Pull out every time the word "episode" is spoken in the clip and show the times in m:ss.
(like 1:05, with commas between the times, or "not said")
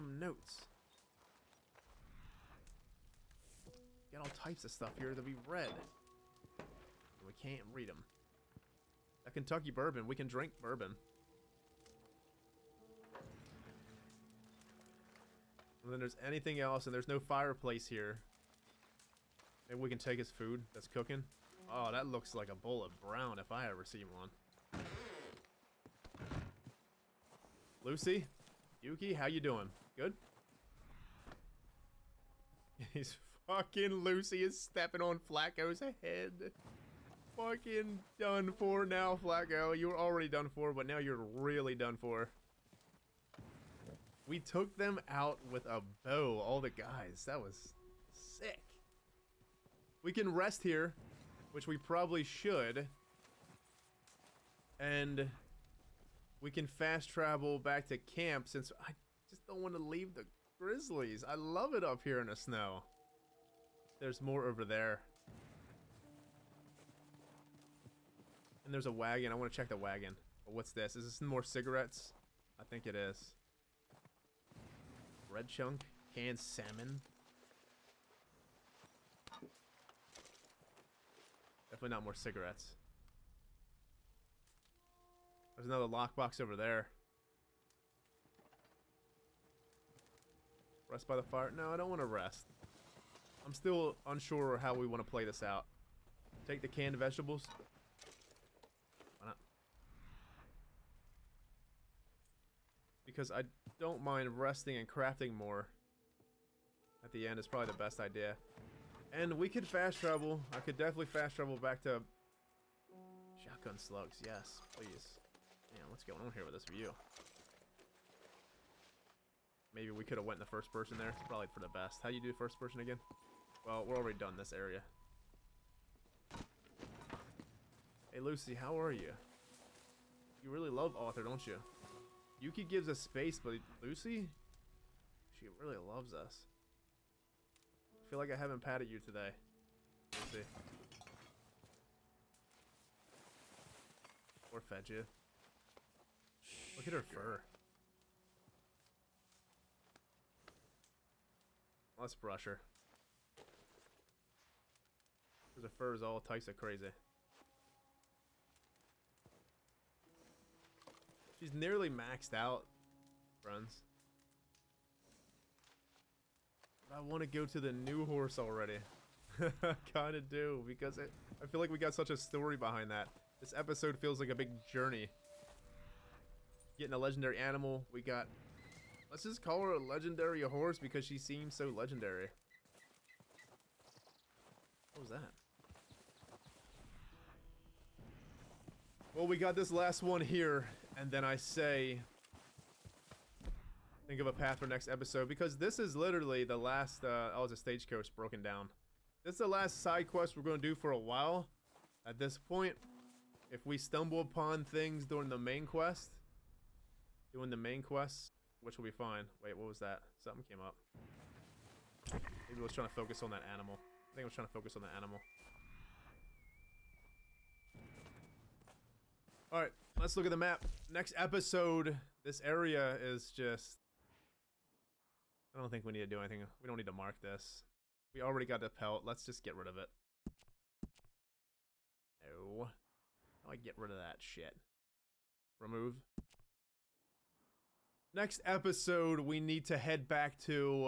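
2:53, 3:14, 3:41, 3:58.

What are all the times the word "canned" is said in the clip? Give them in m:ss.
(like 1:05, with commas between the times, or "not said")
1:16, 1:36.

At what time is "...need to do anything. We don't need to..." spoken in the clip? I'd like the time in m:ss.
3:45.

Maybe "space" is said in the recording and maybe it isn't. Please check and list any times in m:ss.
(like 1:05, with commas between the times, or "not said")
2:13.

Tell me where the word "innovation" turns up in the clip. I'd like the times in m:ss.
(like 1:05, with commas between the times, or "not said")
not said.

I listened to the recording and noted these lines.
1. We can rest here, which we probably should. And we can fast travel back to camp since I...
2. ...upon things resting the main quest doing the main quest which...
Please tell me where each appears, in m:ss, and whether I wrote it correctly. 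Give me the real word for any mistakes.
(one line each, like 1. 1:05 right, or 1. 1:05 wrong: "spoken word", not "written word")
1. 0:50 right
2. 3:24 wrong: "during", not "resting".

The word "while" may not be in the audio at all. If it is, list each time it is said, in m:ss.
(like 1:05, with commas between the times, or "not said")
3:20.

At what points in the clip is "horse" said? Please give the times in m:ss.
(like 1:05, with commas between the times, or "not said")
2:48, 3:00.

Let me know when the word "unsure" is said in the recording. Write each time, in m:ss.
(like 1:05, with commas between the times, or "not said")
1:34.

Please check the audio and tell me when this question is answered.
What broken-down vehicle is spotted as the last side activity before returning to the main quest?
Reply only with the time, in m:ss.
3:17.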